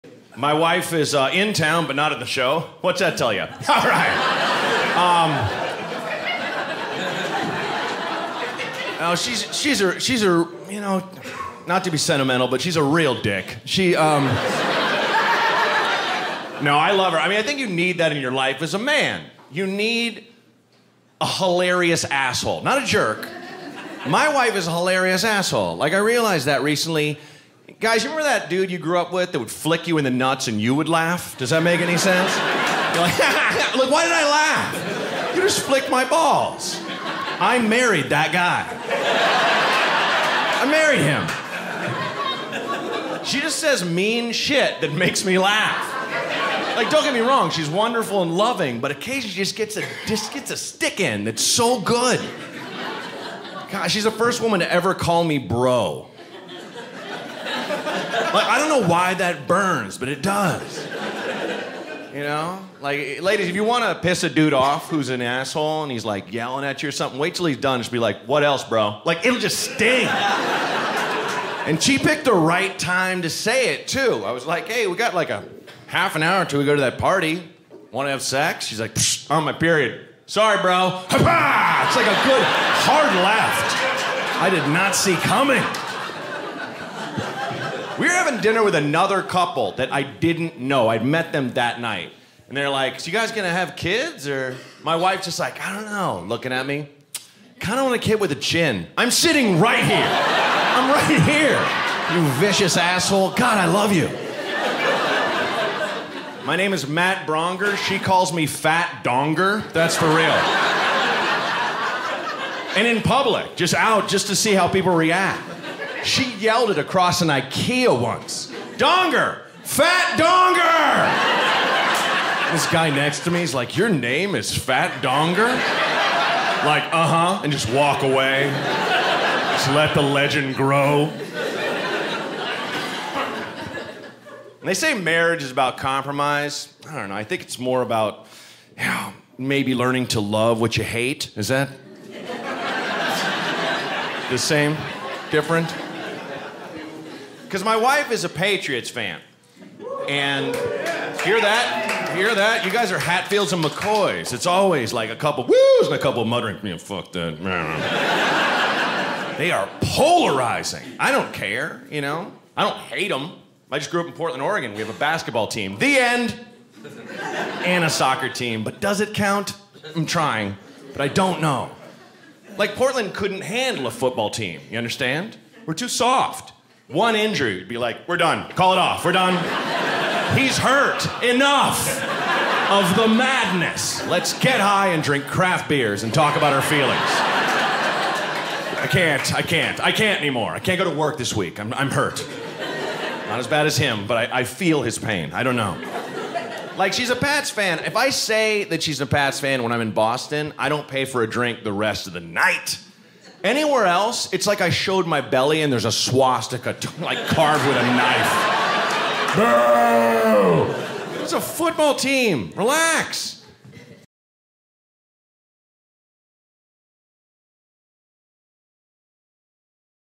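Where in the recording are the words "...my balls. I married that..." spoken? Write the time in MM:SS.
00:35.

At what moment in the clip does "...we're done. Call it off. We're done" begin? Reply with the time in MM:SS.
02:58.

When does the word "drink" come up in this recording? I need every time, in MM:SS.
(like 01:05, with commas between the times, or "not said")
03:05, 03:21.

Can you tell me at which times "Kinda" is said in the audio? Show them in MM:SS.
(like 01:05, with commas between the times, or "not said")
01:37.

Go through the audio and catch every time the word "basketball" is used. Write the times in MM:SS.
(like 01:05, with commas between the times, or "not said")
02:44.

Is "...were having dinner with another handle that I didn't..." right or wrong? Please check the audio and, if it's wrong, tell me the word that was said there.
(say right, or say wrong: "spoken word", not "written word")
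wrong: "couple", not "handle".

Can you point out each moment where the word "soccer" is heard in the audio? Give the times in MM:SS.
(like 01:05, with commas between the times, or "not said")
02:47.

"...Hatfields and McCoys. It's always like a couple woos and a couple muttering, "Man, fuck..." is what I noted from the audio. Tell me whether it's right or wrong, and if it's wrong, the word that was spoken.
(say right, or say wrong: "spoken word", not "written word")
right.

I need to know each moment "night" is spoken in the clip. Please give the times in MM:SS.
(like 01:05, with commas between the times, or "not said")
01:31, 03:22.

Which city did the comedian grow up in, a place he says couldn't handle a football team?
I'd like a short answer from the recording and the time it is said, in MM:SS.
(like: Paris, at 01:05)
Portland, Oregon, at 02:44.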